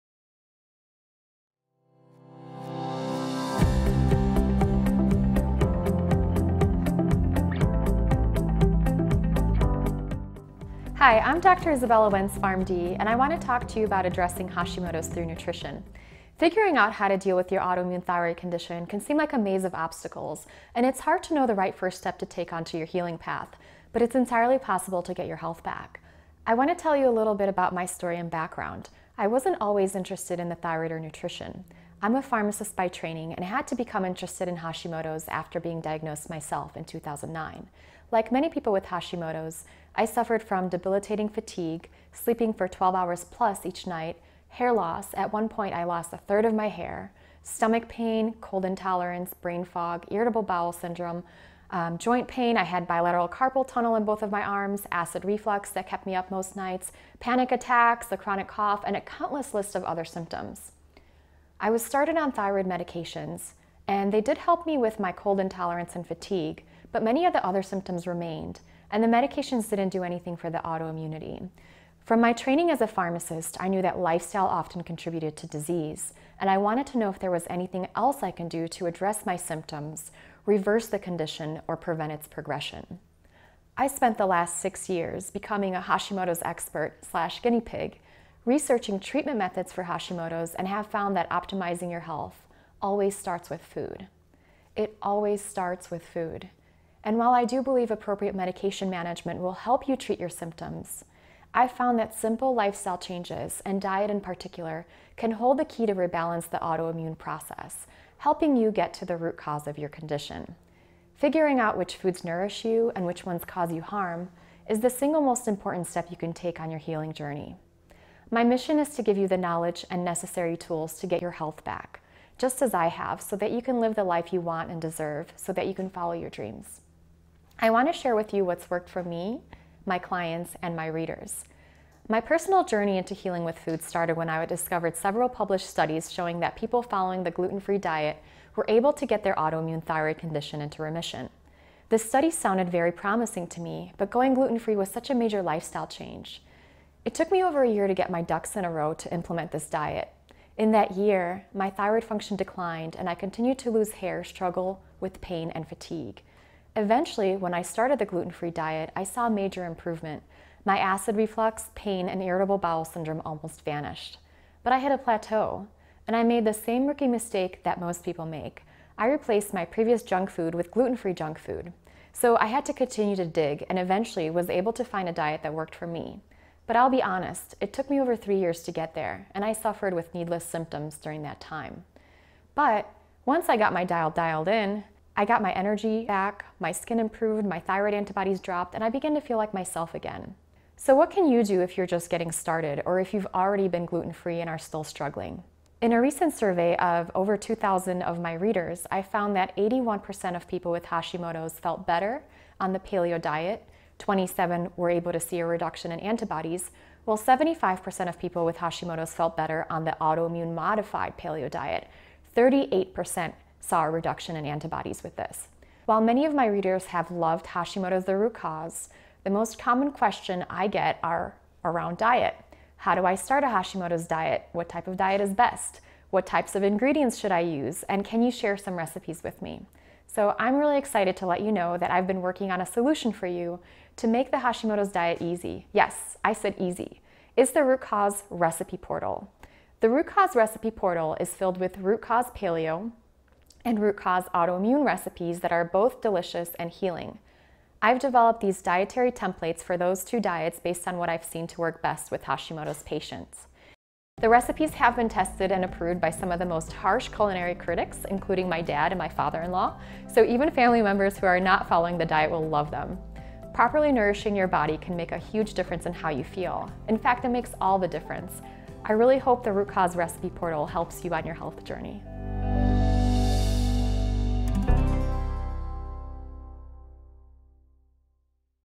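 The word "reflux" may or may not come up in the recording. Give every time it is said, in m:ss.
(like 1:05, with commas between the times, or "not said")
0:55, 2:41.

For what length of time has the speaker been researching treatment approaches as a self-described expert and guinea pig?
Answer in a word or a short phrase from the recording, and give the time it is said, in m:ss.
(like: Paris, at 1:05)
6 years, at 1:24.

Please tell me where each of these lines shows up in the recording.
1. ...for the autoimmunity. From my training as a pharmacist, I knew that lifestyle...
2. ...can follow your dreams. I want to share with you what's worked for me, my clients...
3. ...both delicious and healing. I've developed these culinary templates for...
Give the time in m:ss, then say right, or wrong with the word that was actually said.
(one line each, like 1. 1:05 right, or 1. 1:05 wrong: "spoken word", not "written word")
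1. 1:10 right
2. 2:05 right
3. 4:05 wrong: "dietary", not "culinary".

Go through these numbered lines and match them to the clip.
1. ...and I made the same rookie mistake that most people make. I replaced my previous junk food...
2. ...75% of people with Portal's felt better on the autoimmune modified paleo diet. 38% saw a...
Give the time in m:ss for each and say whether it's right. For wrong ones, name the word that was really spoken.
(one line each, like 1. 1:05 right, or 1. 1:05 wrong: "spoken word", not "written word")
1. 2:46 right
2. 3:27 wrong: "Hashimoto", not "Portal".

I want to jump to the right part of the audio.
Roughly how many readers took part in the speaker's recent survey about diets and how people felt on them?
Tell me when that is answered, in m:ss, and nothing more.
3:17.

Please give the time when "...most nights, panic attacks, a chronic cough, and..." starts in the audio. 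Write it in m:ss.
0:56.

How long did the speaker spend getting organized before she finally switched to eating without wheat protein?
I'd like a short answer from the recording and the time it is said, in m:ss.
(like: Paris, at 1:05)
over a year, at 2:27.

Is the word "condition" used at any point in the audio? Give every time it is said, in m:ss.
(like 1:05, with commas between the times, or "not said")
0:18, 1:20, 1:49, 2:20.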